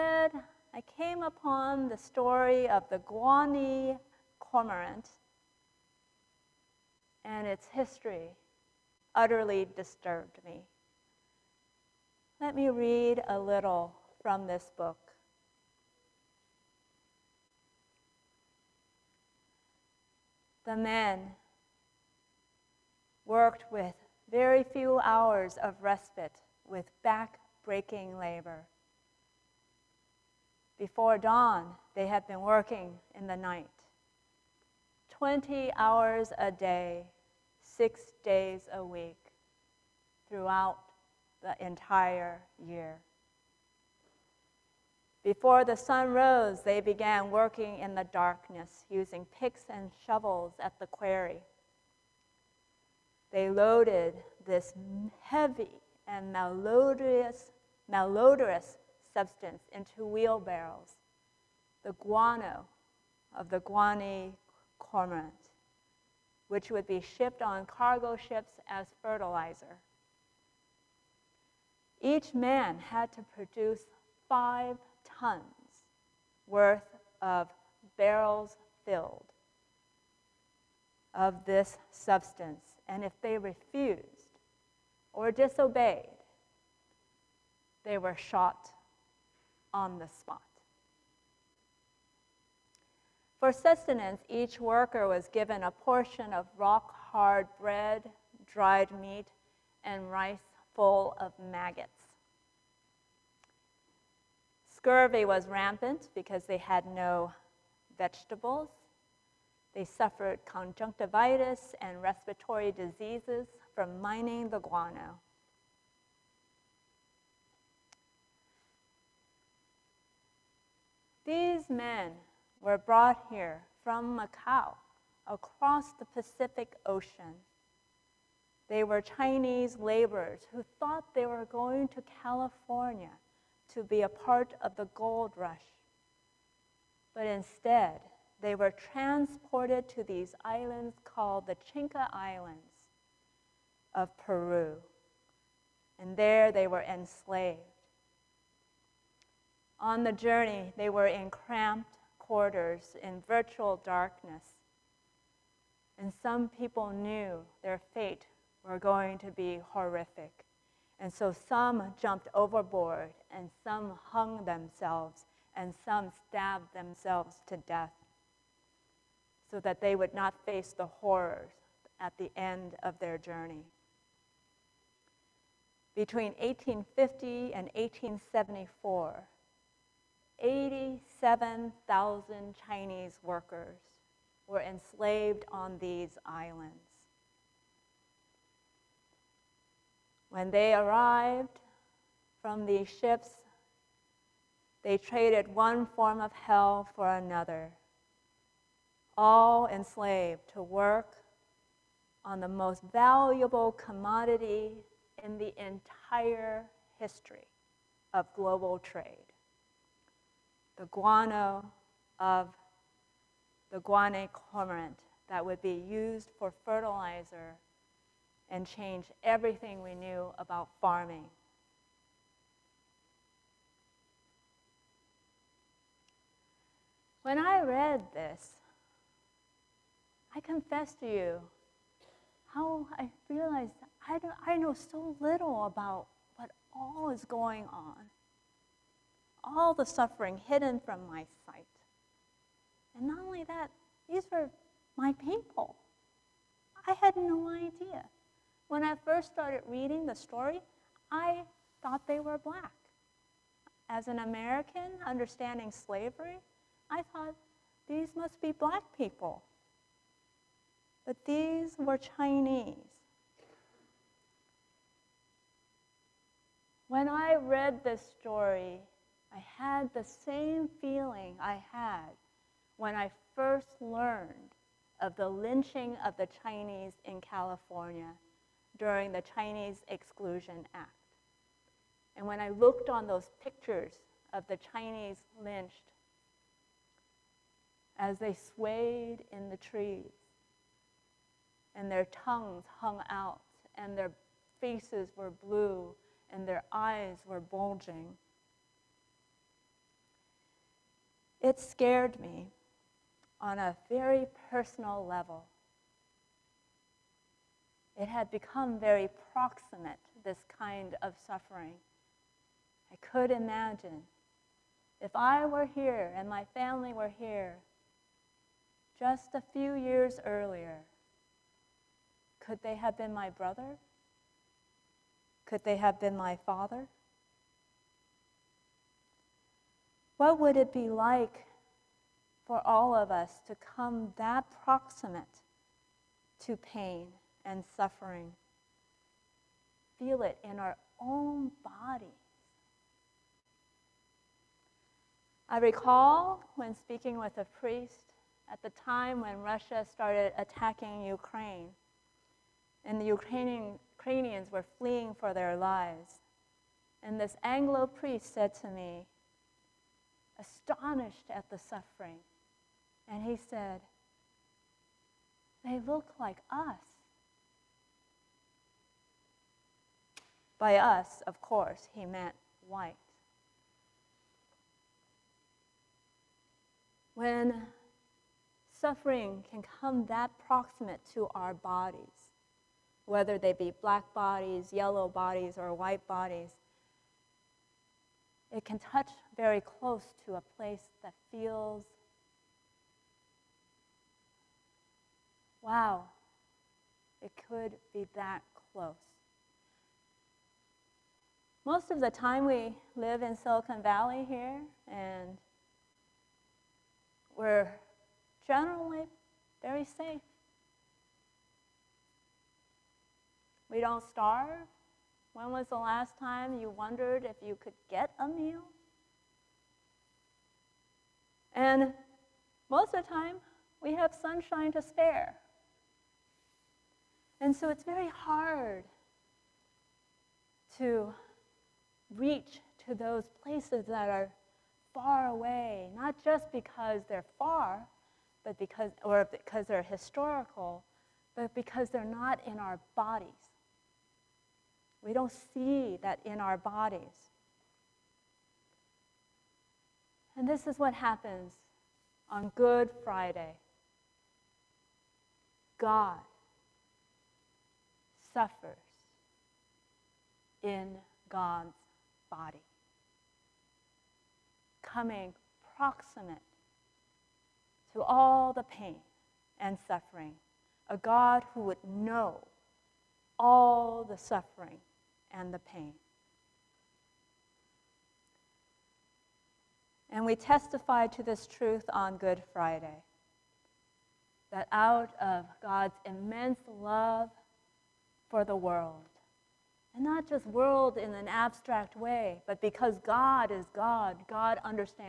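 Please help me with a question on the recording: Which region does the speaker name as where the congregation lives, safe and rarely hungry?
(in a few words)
Silicon Valley.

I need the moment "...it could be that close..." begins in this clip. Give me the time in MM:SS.
06:37.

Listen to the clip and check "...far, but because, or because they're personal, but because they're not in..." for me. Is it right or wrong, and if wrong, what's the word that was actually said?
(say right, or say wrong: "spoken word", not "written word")
wrong: "historical", not "personal".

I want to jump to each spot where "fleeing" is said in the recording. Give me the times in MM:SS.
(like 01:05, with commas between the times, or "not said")
05:54.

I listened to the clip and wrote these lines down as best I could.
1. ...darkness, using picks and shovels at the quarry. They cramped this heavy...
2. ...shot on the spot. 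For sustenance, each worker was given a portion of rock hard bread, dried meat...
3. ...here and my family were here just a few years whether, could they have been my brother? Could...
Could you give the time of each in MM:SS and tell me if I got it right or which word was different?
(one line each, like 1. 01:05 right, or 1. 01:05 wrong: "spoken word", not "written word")
1. 00:48 wrong: "loaded", not "cramped"
2. 01:28 right
3. 05:15 wrong: "earlier", not "whether".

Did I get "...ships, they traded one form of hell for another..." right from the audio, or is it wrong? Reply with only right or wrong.
right.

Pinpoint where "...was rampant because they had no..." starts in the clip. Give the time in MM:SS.
01:45.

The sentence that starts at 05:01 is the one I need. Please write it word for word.
It scared me on a very personal level it had become very proximate, this kind of suffering.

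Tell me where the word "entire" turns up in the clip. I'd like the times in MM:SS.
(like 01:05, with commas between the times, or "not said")
00:41, 03:25.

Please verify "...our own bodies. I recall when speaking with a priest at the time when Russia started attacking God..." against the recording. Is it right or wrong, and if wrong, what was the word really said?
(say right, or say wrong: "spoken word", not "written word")
wrong: "Ukraine", not "God".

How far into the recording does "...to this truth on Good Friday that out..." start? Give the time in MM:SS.
08:01.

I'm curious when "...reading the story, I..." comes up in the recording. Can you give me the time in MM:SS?
04:09.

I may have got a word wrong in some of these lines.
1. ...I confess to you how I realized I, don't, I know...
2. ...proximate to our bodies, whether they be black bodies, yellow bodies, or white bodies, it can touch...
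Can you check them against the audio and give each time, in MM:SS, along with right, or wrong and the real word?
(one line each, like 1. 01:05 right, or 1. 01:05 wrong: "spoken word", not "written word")
1. 03:50 right
2. 06:20 right.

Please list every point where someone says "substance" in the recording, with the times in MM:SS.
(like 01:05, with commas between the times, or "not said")
00:59, 01:21.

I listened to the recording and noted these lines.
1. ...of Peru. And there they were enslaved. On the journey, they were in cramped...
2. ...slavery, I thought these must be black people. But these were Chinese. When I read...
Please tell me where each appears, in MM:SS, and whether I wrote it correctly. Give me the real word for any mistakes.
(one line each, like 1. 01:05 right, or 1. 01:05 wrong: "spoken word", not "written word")
1. 02:23 right
2. 04:15 right.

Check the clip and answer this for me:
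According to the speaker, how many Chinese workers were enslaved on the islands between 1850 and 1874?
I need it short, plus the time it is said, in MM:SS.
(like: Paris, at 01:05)
87,000, at 03:00.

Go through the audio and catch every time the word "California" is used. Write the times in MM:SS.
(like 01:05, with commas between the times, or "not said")
02:12, 04:37.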